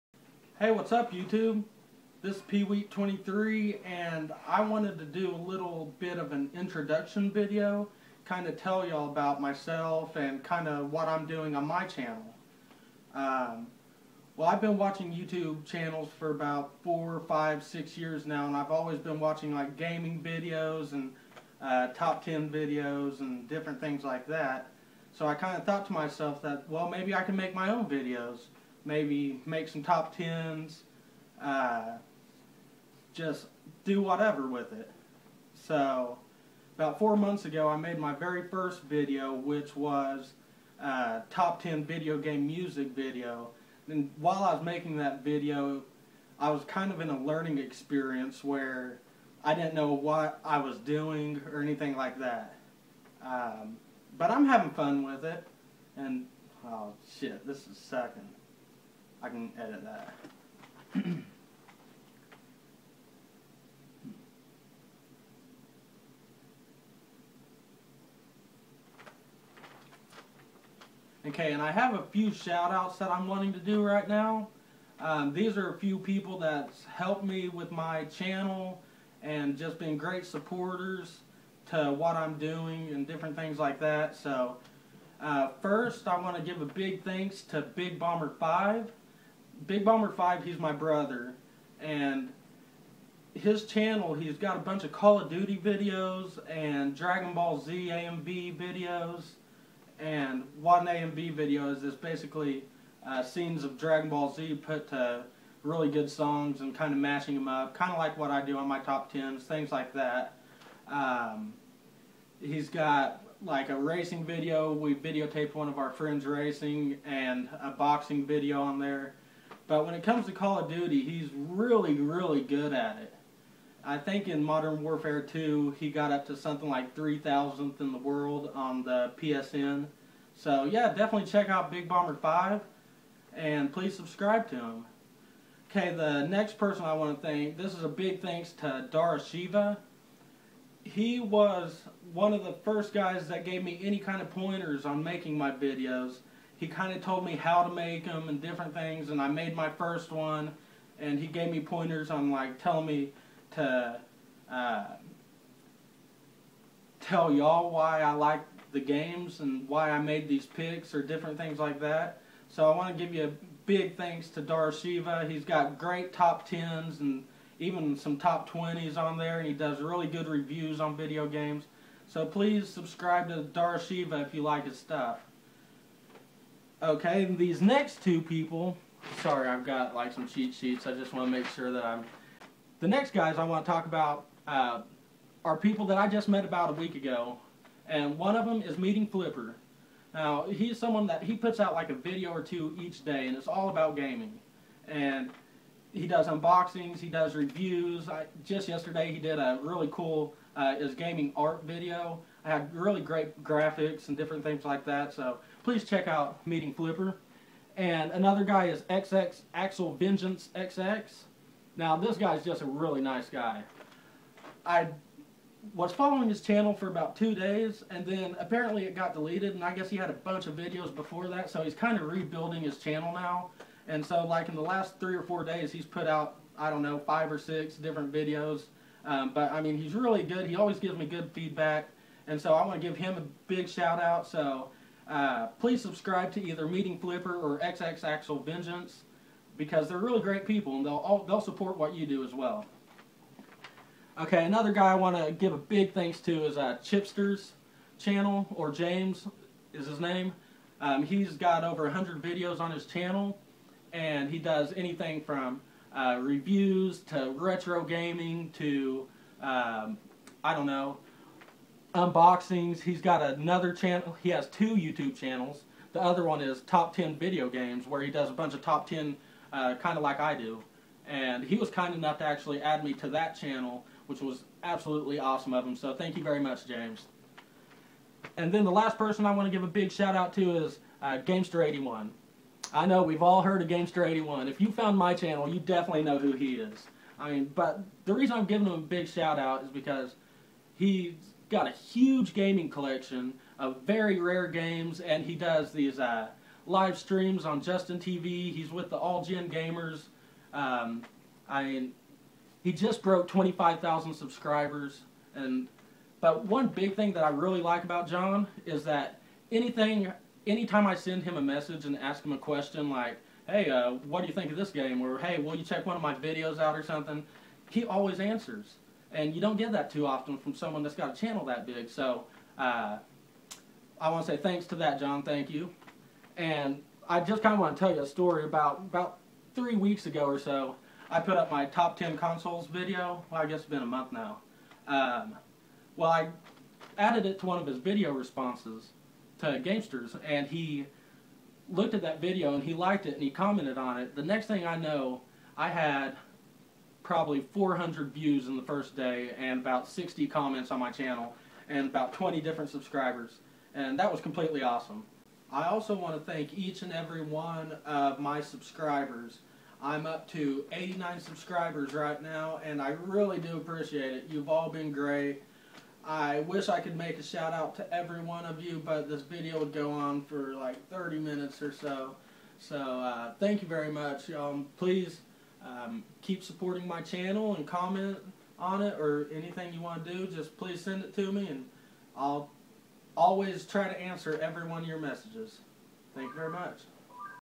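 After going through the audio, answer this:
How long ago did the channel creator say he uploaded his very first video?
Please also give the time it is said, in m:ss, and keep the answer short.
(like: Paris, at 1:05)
4 months, at 0:36.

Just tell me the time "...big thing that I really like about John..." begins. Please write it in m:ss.
5:06.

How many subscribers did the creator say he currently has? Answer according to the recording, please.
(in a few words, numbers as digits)
89.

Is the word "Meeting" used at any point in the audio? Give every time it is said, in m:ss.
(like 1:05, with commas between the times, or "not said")
3:08, 3:26, 3:56.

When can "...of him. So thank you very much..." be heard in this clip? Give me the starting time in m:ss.
4:35.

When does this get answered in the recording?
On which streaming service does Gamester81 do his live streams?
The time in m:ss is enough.
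4:57.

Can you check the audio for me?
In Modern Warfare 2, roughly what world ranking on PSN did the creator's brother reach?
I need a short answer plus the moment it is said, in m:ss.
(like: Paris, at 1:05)
3,000th, at 2:06.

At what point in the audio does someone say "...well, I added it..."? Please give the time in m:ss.
5:35.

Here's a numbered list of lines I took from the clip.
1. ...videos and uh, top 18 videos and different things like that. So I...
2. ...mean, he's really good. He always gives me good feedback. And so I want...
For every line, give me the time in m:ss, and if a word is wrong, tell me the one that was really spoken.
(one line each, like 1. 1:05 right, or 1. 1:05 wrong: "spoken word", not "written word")
1. 0:20 wrong: "10", not "18"
2. 3:49 right.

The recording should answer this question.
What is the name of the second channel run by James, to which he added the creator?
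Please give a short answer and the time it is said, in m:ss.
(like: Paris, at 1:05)
Top 10 Video Games, at 4:26.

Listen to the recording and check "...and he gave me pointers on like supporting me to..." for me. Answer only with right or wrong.
wrong.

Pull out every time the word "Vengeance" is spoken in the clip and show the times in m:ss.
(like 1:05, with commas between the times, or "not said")
3:29, 3:58.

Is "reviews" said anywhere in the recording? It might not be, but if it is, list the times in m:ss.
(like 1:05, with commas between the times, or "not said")
2:50, 3:17, 4:16.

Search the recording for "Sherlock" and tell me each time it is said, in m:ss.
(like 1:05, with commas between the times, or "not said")
not said.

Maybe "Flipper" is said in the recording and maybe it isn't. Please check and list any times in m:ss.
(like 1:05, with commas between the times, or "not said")
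3:09, 3:26, 3:56.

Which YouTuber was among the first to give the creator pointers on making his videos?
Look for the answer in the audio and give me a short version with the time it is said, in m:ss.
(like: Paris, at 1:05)
Darashiva, at 2:18.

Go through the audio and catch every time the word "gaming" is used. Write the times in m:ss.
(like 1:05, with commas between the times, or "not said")
0:19, 3:13, 3:20, 4:17, 4:52.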